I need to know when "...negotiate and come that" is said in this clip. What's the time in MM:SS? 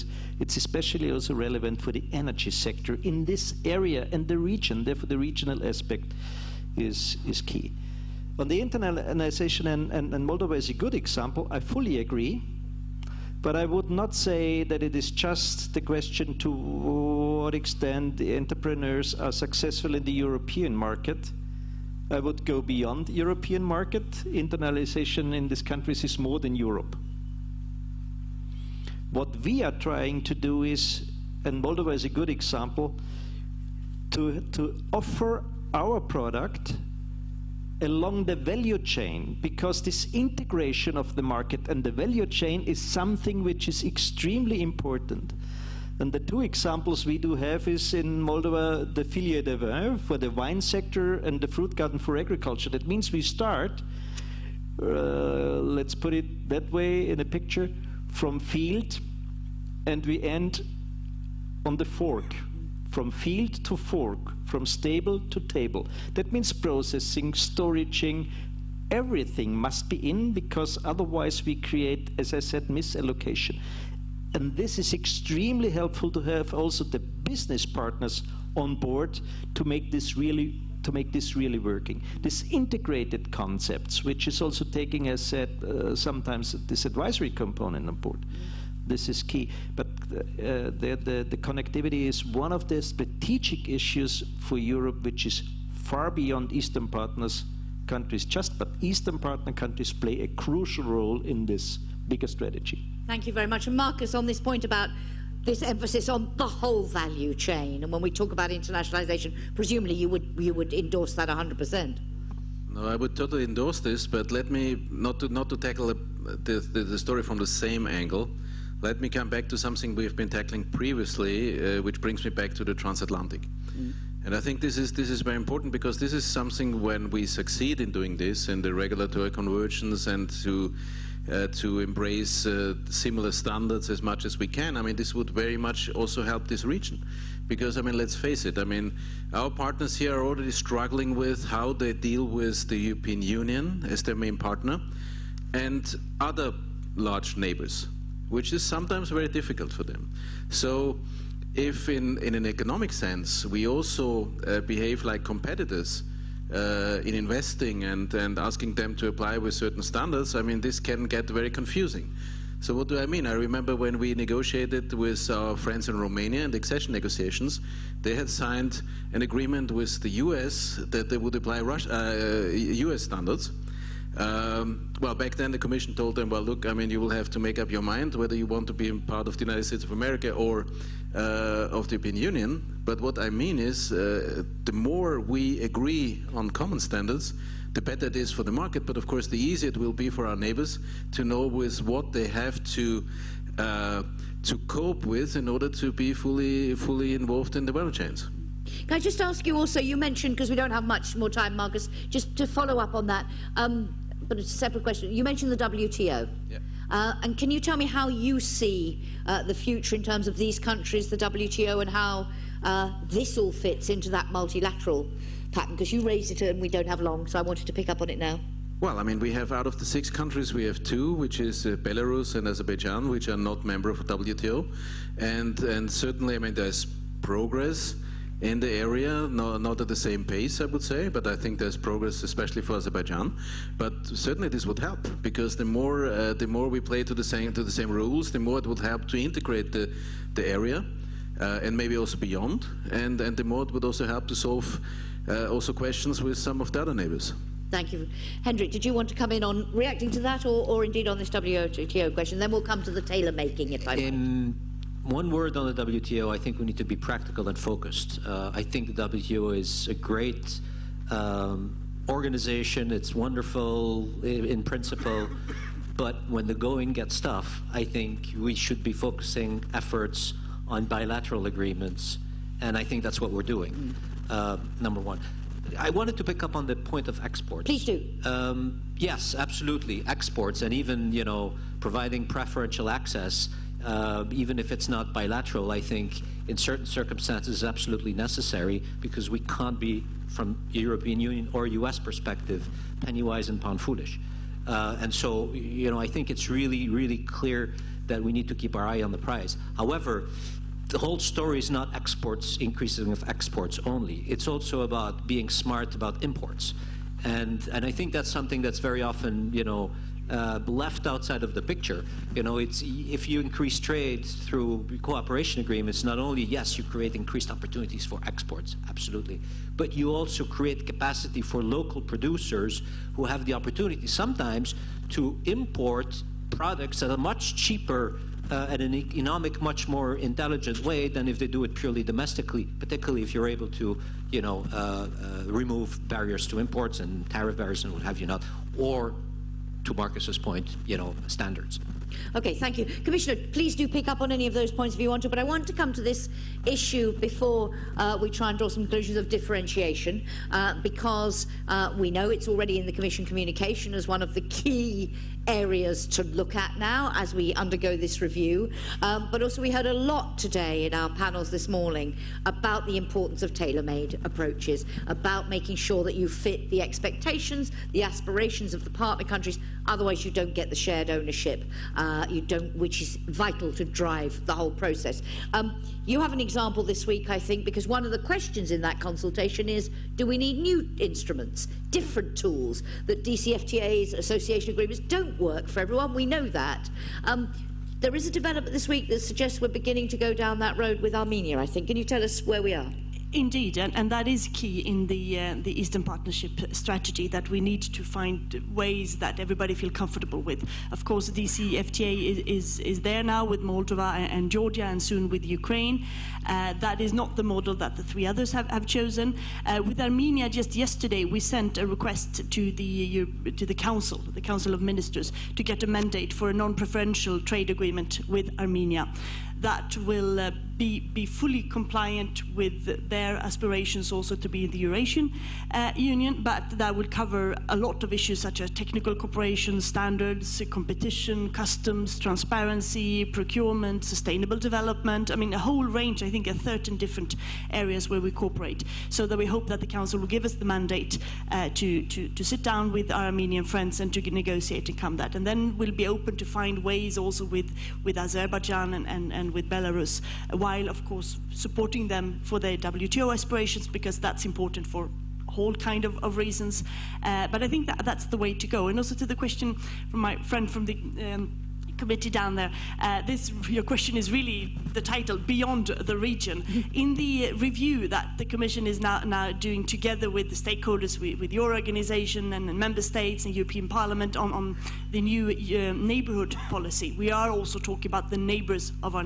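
07:24.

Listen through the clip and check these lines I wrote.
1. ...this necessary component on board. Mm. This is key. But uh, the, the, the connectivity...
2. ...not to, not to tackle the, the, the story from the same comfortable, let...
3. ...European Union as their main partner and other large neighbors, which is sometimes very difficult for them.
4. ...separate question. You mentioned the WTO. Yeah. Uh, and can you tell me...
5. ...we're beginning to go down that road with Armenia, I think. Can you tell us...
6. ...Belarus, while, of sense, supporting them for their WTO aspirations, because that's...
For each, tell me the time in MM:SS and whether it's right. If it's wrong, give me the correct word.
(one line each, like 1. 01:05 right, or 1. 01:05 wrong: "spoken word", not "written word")
1. 01:26 wrong: "advisory", not "necessary"
2. 01:54 wrong: "angle", not "comfortable"
3. 02:22 right
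4. 03:24 right
5. 06:29 right
6. 07:29 wrong: "course", not "sense".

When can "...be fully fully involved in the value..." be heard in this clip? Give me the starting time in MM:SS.
03:15.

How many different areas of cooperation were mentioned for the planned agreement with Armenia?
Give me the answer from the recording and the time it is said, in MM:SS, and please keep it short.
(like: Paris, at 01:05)
13, at 07:16.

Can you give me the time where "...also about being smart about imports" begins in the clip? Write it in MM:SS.
05:04.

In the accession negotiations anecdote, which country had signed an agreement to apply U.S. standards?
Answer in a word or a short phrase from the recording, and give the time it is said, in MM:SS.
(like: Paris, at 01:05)
Romania, at 02:45.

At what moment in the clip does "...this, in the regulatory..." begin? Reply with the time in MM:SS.
02:08.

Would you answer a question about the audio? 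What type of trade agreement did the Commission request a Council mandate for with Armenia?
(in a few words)
non-preferential trade agreement.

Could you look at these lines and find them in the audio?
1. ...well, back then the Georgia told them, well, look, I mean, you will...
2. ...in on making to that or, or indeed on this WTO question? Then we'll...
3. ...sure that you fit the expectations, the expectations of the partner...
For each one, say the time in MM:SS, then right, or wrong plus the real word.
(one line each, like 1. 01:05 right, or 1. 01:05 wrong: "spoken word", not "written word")
1. 02:54 wrong: "Commission", not "Georgia"
2. 04:09 wrong: "reacting", not "making"
3. 06:05 wrong: "aspirations", not "expectations".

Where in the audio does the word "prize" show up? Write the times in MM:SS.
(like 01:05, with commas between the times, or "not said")
04:59.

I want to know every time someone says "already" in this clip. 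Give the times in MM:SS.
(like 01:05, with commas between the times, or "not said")
02:20, 05:52.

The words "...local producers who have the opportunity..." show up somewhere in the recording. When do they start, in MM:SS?
05:21.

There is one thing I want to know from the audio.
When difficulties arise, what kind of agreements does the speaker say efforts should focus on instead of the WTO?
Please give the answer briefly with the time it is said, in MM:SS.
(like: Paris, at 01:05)
bilateral agreements, at 04:30.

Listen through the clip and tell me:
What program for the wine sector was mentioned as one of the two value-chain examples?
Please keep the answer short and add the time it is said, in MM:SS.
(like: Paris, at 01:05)
Filière du Vin, at 00:49.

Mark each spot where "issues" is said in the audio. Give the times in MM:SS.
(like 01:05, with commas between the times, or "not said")
01:33, 05:46, 07:08.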